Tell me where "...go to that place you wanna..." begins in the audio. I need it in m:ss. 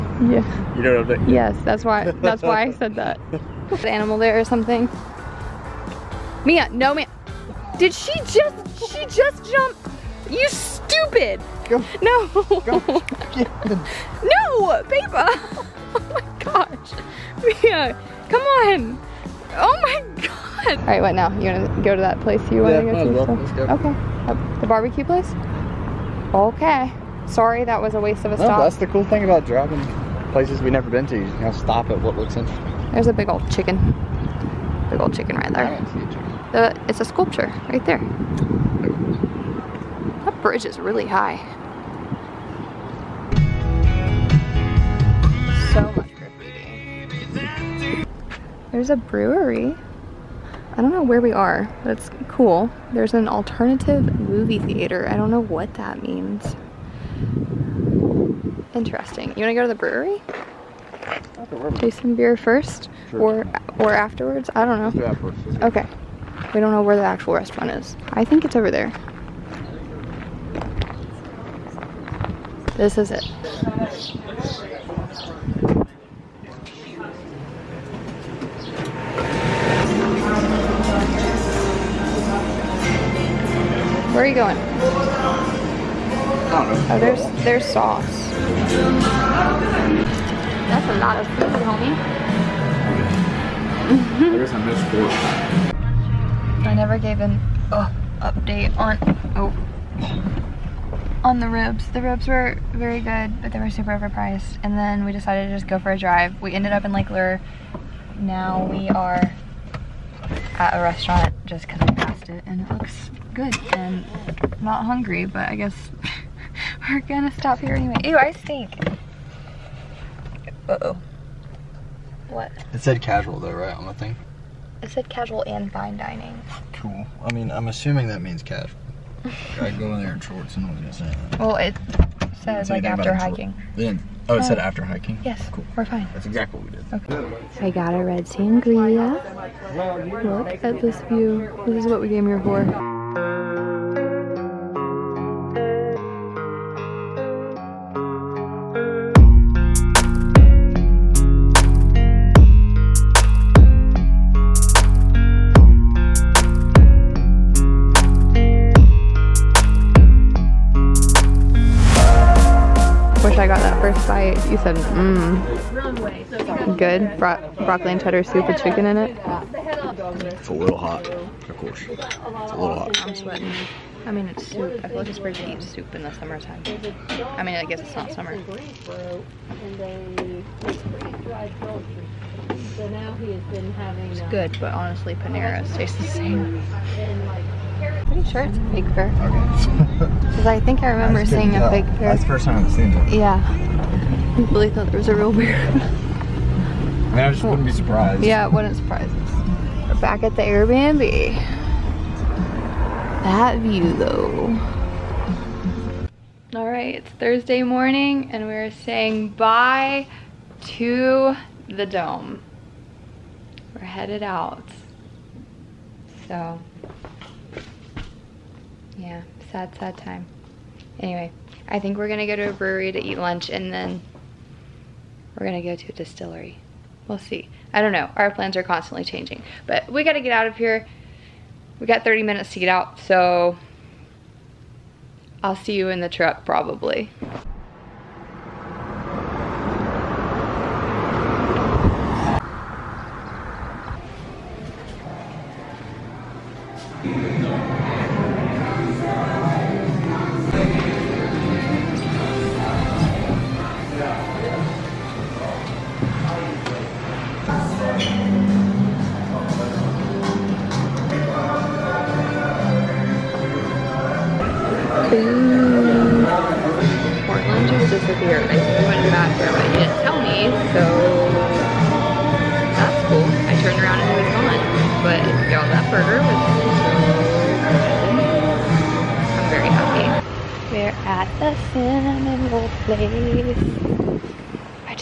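0:21.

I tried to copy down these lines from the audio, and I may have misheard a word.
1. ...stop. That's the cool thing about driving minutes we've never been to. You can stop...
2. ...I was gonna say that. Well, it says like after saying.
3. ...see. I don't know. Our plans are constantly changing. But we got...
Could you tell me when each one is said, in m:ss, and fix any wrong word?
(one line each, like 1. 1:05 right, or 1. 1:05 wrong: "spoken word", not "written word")
1. 0:28 wrong: "places", not "minutes"
2. 2:10 wrong: "hiking", not "saying"
3. 3:47 right.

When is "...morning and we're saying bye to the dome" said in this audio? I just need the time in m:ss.
3:27.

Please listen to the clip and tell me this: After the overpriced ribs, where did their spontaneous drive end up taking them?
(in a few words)
Lake Lure.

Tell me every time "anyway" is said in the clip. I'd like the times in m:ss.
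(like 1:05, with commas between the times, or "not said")
1:57, 3:40.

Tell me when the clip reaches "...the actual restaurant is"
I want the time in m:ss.
1:06.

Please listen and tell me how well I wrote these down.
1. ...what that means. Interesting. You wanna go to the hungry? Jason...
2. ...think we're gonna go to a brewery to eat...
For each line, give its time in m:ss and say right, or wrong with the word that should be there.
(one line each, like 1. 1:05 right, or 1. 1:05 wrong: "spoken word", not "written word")
1. 0:55 wrong: "brewery", not "hungry"
2. 3:41 right.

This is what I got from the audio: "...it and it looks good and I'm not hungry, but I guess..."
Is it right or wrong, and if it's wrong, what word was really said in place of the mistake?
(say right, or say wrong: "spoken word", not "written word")
right.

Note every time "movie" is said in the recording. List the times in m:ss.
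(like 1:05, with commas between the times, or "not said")
0:54.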